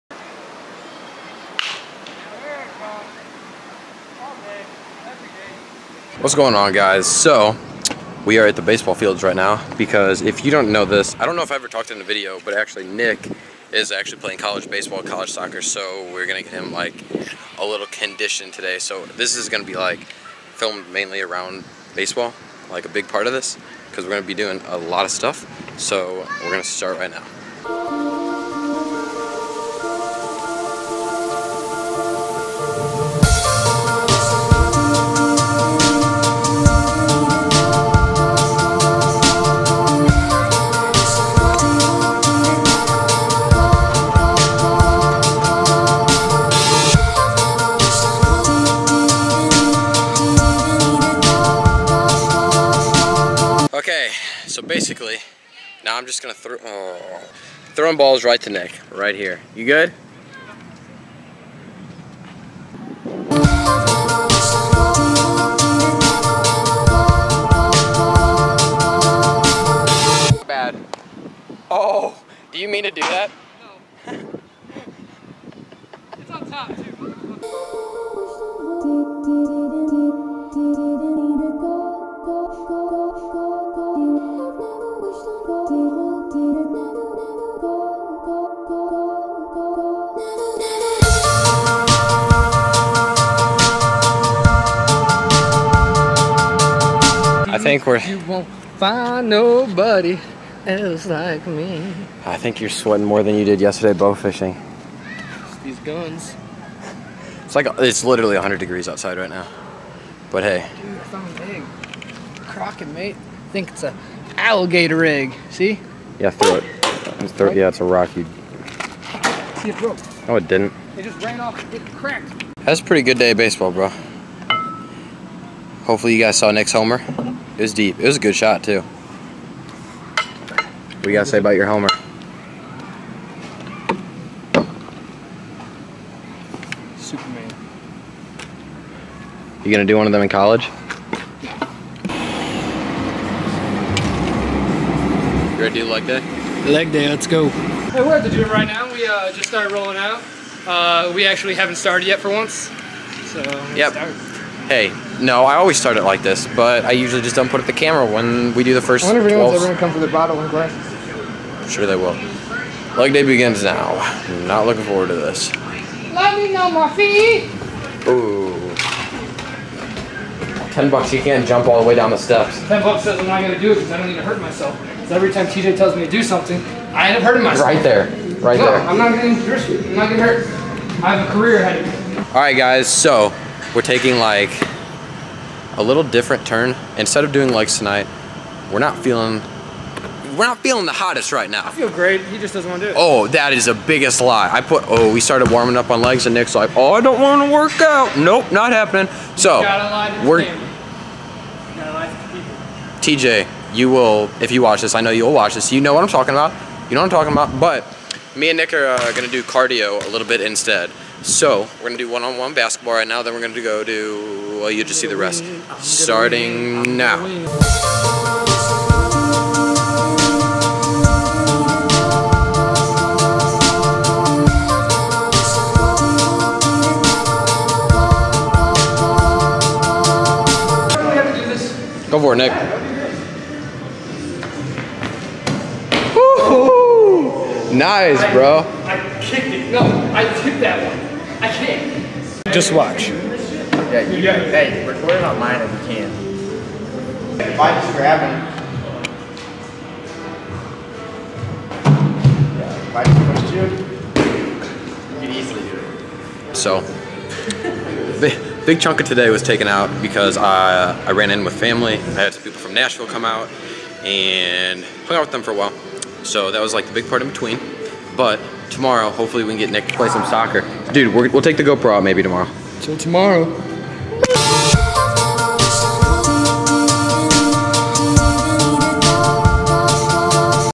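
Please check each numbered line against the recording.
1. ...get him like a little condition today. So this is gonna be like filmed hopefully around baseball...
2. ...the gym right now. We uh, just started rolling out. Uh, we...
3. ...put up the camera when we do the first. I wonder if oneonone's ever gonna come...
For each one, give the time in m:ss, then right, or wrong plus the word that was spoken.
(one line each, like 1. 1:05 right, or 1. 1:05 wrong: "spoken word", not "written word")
1. 0:16 wrong: "mainly", not "hopefully"
2. 2:28 right
3. 2:37 wrong: "anyone", not "oneonone".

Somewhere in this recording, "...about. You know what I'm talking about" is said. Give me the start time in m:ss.
3:26.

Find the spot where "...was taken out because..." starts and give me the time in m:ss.
4:19.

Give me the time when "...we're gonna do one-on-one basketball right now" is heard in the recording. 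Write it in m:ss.
3:31.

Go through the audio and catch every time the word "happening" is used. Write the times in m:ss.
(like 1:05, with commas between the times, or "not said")
3:18.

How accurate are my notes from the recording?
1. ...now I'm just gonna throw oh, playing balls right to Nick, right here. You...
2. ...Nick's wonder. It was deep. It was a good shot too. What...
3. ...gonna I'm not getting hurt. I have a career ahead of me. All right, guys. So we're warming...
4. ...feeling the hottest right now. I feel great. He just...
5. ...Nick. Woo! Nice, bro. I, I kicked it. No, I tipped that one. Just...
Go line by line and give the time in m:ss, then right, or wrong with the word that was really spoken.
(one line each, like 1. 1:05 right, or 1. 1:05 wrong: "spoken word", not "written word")
1. 0:55 wrong: "throwing", not "playing"
2. 2:06 wrong: "homer", not "wonder"
3. 2:59 wrong: "taking", not "warming"
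4. 3:10 right
5. 3:52 right.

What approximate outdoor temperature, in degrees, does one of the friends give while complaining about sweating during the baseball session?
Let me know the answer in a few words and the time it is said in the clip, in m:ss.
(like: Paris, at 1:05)
100 degrees, at 1:48.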